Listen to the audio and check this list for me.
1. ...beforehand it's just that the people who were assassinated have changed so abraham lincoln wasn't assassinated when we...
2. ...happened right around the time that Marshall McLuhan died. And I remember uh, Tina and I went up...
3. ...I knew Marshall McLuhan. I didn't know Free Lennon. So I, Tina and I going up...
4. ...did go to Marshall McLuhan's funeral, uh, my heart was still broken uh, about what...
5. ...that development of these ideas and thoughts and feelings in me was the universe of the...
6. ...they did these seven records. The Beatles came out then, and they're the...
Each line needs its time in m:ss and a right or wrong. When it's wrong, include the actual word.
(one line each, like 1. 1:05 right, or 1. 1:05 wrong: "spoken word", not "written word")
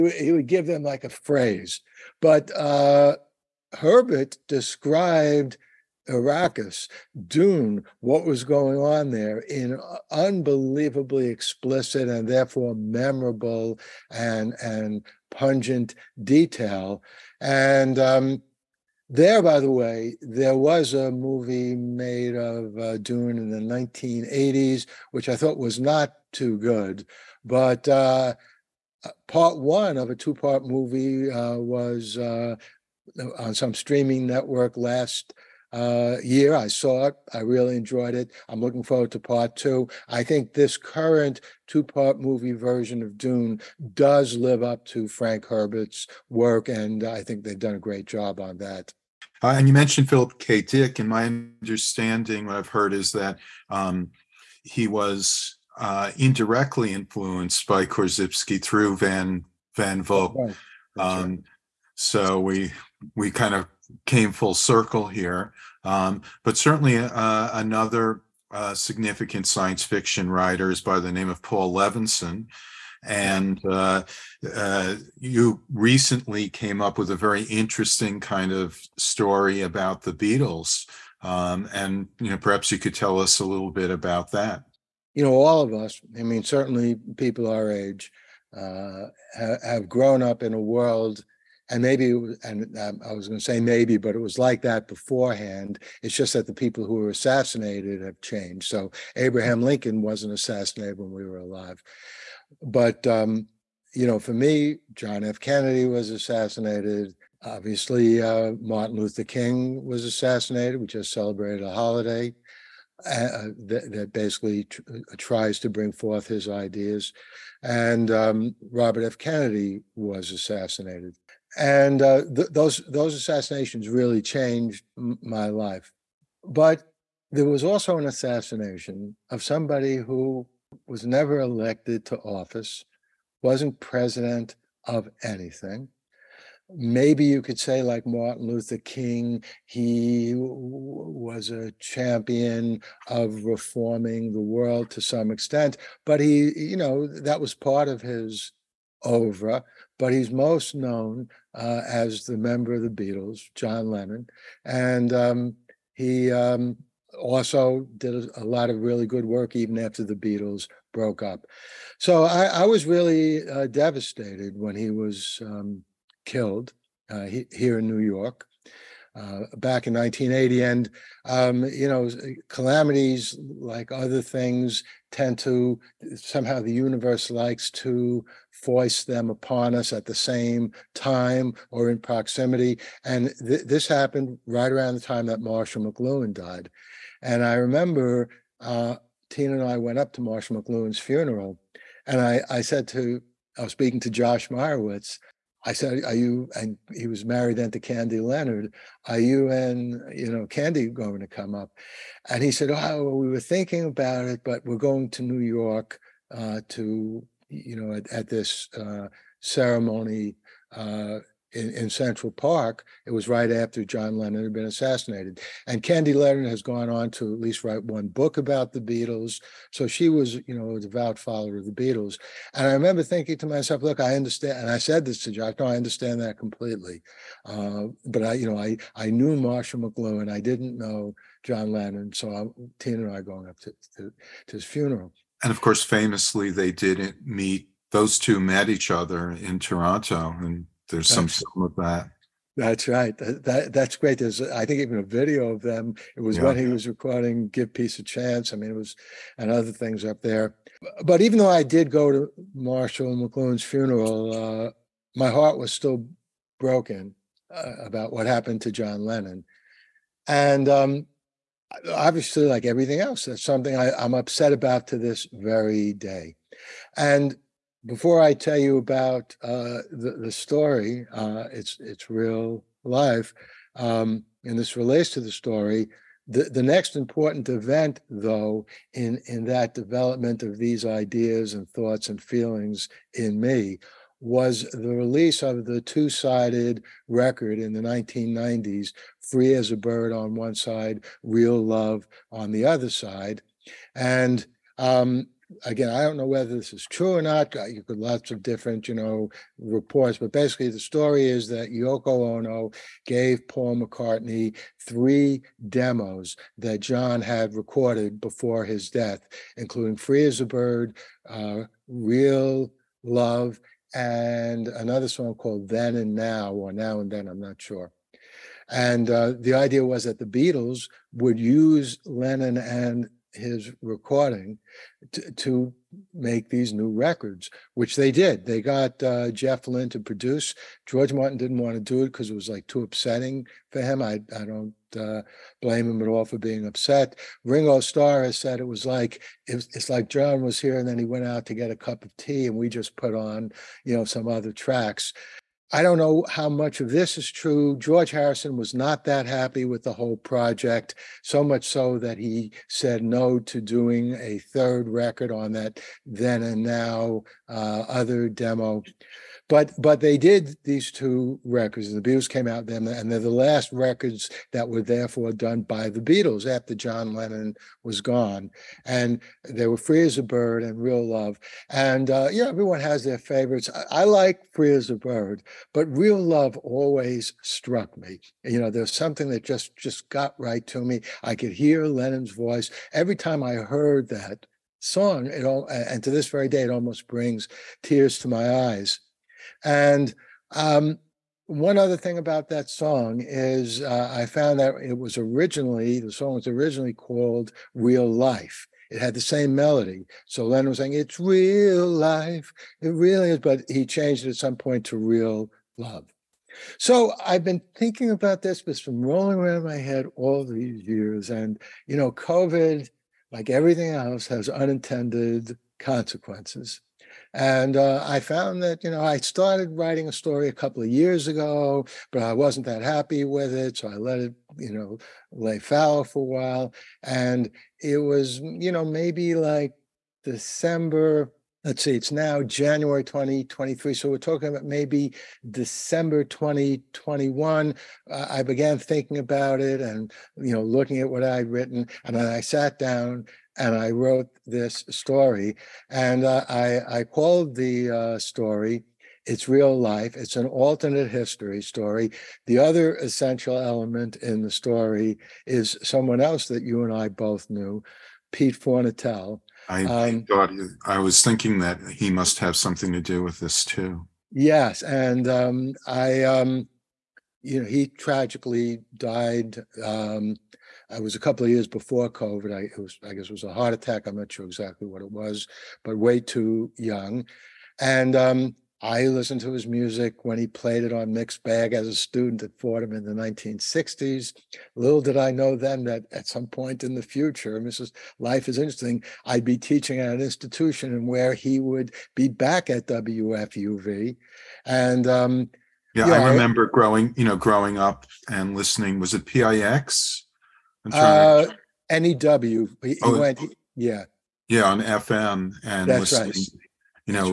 1. 1:34 right
2. 3:03 right
3. 3:48 wrong: "John", not "Free"
4. 4:11 right
5. 4:39 wrong: "release", not "universe"
6. 6:00 wrong: "two", not "seven".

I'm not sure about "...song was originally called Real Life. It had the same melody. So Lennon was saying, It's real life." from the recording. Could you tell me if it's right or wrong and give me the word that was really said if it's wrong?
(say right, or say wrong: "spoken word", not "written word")
right.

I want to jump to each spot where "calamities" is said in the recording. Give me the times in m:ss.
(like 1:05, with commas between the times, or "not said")
2:52.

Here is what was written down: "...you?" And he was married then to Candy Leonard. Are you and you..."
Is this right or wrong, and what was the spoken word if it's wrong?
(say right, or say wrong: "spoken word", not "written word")
right.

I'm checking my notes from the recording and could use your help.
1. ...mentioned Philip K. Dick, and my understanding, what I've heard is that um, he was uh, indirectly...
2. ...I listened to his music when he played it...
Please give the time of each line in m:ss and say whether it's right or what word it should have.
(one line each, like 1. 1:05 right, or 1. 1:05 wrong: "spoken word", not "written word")
1. 0:49 right
2. 7:58 right.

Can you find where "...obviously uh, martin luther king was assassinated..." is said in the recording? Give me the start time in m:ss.
1:47.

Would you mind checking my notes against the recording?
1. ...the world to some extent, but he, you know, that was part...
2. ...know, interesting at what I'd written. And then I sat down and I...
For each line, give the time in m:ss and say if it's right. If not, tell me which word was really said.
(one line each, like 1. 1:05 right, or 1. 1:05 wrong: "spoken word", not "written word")
1. 2:24 right
2. 7:20 wrong: "looking", not "interesting".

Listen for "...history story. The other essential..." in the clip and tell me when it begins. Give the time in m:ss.
7:31.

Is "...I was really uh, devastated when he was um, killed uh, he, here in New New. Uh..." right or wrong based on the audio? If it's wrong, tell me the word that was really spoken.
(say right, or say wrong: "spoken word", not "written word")
wrong: "York", not "New".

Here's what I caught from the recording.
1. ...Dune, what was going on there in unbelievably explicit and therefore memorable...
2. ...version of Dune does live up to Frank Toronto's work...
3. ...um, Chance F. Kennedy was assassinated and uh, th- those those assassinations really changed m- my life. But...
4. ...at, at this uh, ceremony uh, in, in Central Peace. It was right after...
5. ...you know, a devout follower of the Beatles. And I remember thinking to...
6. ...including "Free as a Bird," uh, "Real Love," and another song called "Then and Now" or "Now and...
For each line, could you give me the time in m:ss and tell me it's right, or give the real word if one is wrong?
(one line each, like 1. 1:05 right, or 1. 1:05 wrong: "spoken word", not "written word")
1. 0:07 right
2. 0:42 wrong: "Herbert", not "Toronto"
3. 1:58 wrong: "Robert", not "Chance"
4. 3:27 wrong: "Park", not "Peace"
5. 3:40 right
6. 5:09 right.